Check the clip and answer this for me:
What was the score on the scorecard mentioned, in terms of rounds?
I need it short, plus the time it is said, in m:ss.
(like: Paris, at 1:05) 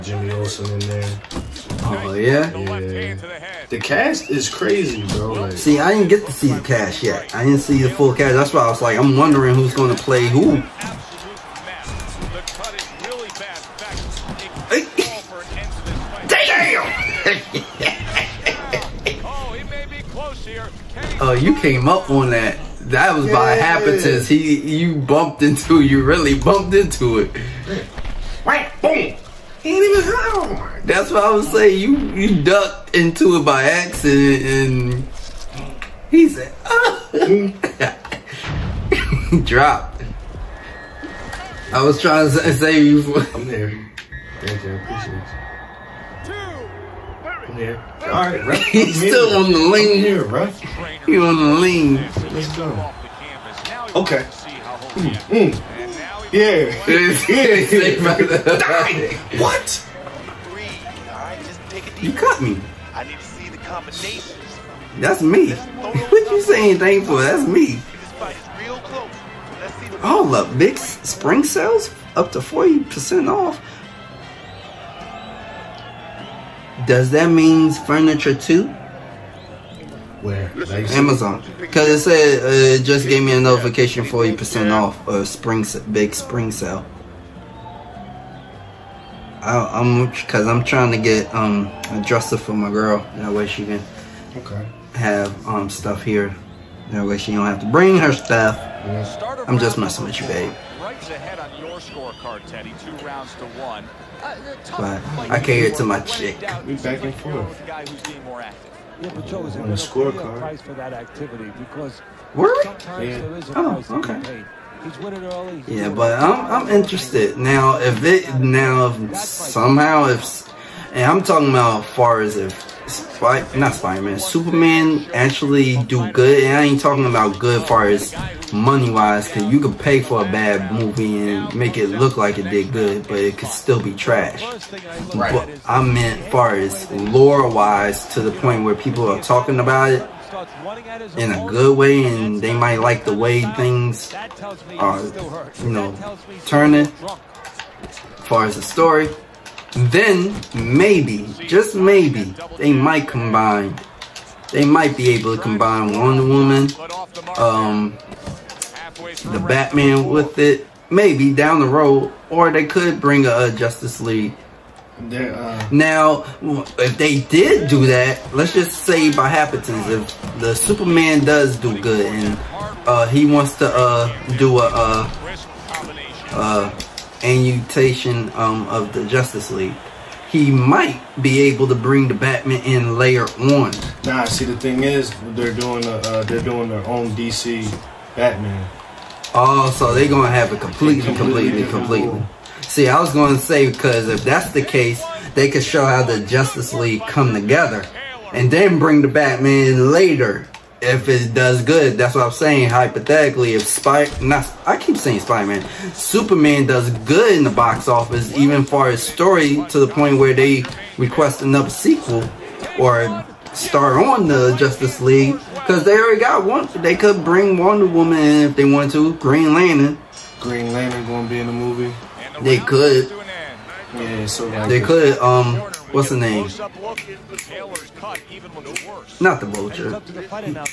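Two rounds to one, at 1:42.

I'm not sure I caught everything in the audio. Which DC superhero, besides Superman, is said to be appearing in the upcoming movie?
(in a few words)
Green Lantern.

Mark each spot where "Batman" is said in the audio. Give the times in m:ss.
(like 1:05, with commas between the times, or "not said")
2:39, 3:02, 3:08, 3:19.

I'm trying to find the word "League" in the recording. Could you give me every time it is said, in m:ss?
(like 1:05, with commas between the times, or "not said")
2:43, 2:59, 3:16, 3:34.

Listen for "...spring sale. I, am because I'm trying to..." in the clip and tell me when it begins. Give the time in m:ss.
1:26.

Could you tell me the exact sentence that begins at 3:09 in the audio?
Oh, so they're gonna have it completely, completely.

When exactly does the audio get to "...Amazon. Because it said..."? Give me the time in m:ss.
1:20.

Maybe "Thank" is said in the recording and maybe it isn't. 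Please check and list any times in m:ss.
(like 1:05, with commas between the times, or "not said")
0:44.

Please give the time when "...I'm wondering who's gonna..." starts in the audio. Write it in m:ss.
0:08.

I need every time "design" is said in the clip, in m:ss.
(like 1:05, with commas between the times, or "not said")
not said.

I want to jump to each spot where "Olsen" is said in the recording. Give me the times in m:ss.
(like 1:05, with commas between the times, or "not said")
0:00.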